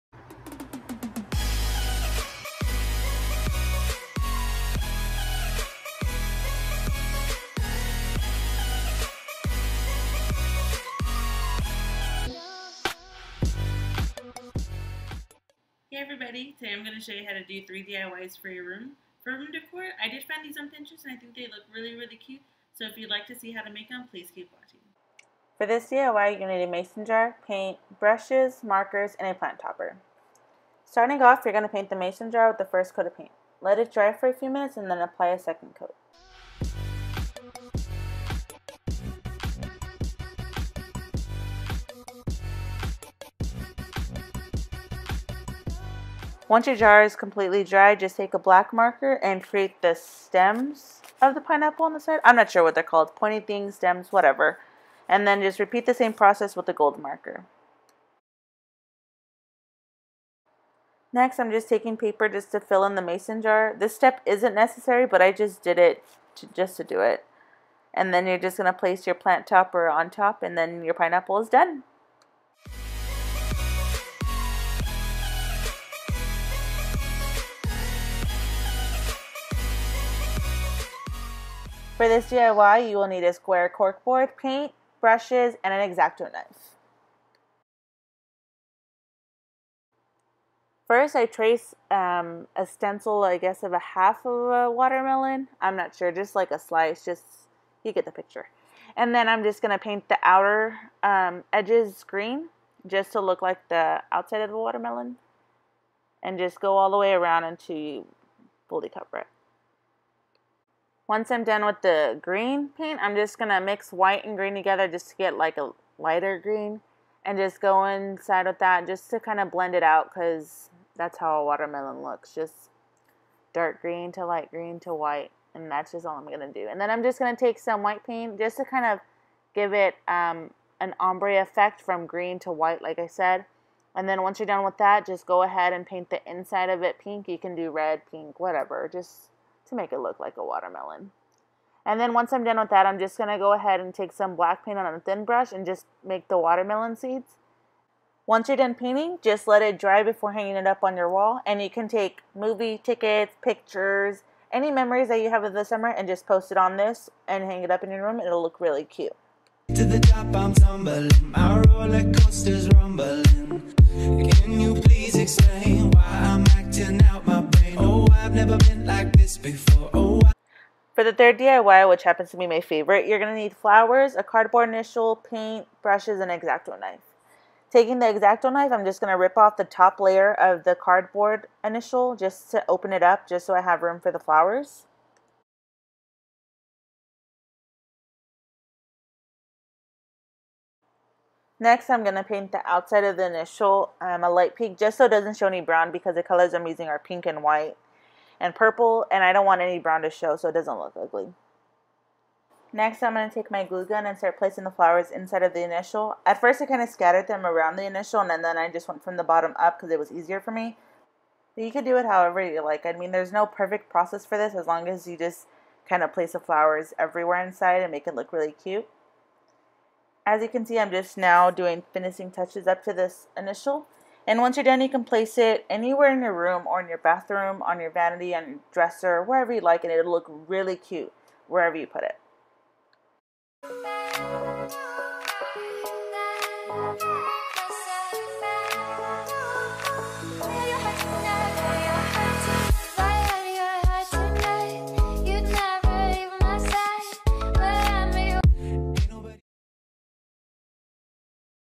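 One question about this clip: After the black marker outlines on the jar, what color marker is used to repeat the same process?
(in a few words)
gold.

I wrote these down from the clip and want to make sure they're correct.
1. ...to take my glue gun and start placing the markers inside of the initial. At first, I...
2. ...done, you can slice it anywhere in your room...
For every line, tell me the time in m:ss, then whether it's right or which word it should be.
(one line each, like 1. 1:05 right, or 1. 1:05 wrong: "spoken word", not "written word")
1. 3:23 wrong: "flowers", not "markers"
2. 3:44 wrong: "place", not "slice".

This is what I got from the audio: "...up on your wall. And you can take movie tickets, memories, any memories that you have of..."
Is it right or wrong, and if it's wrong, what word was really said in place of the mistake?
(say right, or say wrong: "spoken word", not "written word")
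wrong: "pictures", not "memories".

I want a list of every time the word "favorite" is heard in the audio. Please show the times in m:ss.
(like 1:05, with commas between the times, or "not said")
2:52.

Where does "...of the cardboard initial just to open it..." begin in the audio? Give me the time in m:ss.
3:00.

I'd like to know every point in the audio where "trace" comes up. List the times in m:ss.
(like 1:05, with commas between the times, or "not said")
1:31.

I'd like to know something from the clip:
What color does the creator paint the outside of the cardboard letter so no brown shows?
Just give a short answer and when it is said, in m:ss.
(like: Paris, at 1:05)
light pink, at 3:14.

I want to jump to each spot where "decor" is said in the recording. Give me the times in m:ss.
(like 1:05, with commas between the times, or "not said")
0:19.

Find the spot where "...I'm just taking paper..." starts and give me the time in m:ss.
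1:01.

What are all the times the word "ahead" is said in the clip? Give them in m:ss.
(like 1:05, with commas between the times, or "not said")
2:15, 2:23.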